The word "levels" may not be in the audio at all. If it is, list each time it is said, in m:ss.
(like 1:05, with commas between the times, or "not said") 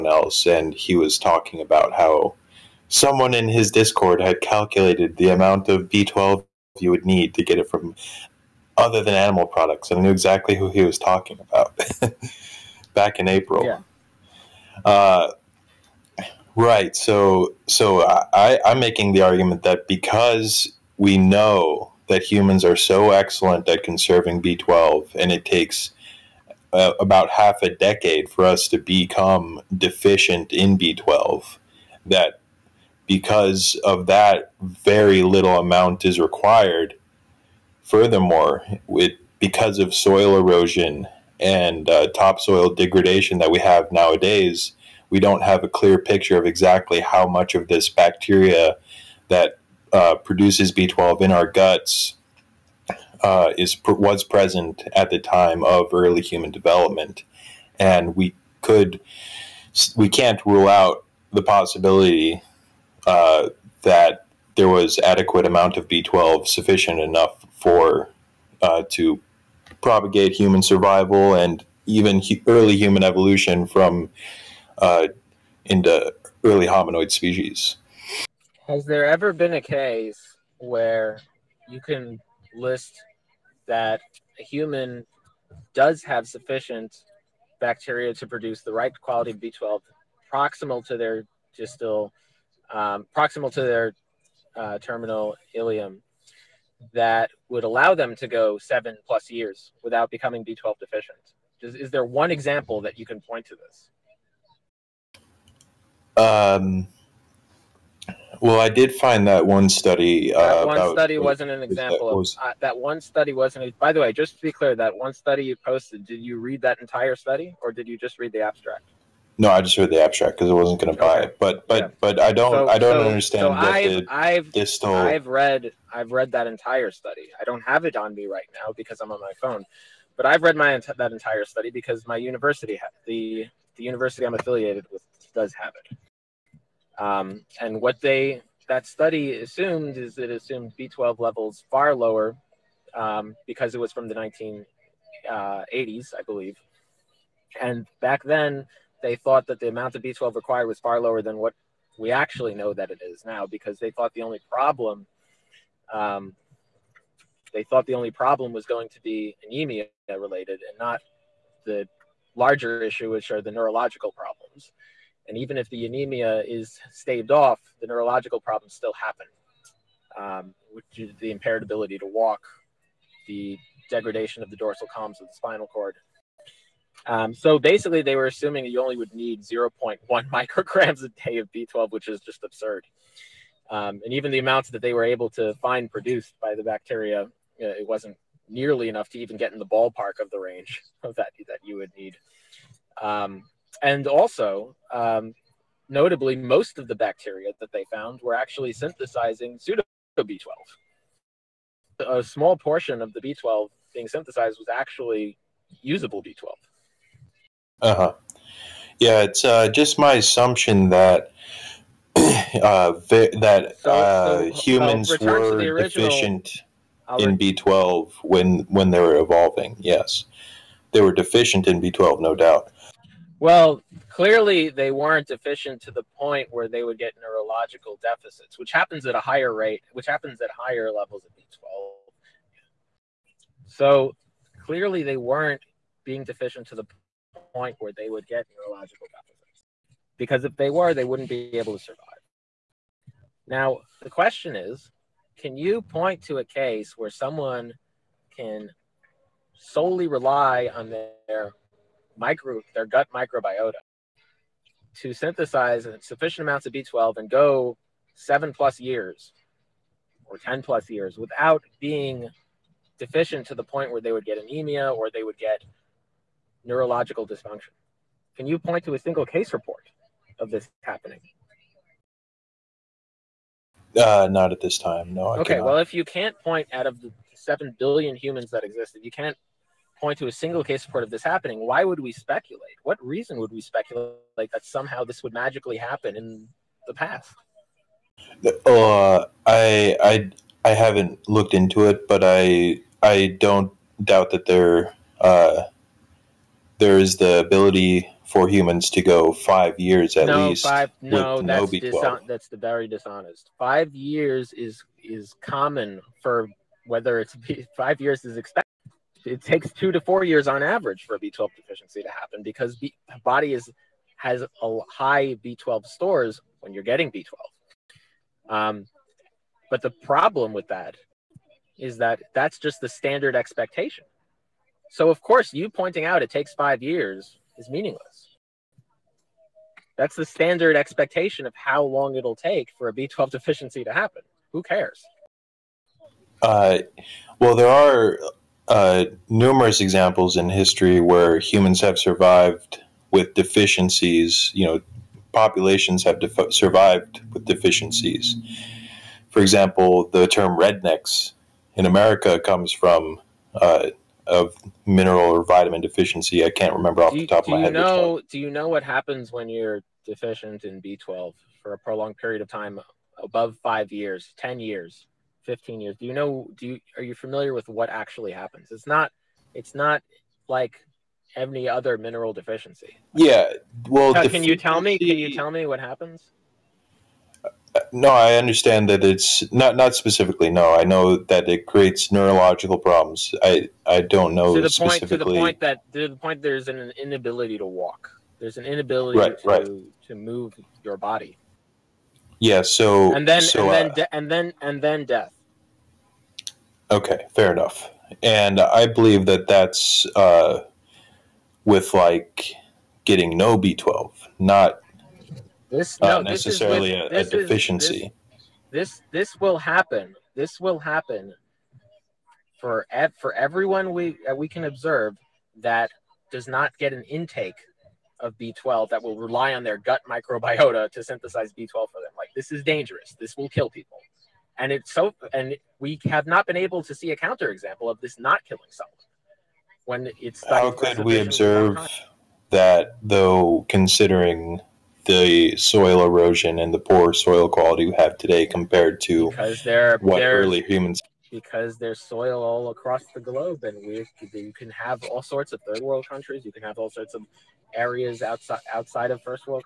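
2:21, 3:50.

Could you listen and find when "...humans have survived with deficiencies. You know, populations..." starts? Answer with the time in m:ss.
5:41.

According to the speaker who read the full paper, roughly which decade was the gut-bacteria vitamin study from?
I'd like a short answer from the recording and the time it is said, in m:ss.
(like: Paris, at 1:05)
1980s, at 2:24.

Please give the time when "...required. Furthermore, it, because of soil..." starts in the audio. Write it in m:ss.
0:36.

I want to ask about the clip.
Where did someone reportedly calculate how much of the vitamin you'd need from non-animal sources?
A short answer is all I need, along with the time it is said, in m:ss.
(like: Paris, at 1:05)
Discord, at 0:03.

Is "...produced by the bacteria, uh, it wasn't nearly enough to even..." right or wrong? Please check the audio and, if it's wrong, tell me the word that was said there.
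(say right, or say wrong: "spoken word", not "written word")
right.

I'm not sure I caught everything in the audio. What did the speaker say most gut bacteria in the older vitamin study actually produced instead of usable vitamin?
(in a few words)
pseudo B12.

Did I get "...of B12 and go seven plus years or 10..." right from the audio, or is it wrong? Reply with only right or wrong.
right.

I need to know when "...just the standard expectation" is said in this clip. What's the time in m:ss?
5:22.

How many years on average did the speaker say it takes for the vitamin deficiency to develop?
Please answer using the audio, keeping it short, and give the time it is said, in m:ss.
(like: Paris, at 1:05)
2 to 4 years, at 5:09.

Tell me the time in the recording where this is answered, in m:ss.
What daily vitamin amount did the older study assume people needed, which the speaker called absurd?
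2:59.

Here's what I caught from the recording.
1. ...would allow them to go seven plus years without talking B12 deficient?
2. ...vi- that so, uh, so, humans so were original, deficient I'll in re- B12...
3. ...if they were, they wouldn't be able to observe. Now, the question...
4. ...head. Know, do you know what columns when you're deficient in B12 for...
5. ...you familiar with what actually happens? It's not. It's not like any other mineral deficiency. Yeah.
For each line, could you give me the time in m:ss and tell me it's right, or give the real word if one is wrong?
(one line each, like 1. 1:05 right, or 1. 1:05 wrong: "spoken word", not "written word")
1. 1:37 wrong: "becoming", not "talking"
2. 3:32 right
3. 4:00 wrong: "survive", not "observe"
4. 5:57 wrong: "happens", not "columns"
5. 6:07 right.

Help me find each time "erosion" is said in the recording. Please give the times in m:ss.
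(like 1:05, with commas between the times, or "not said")
0:40, 7:16.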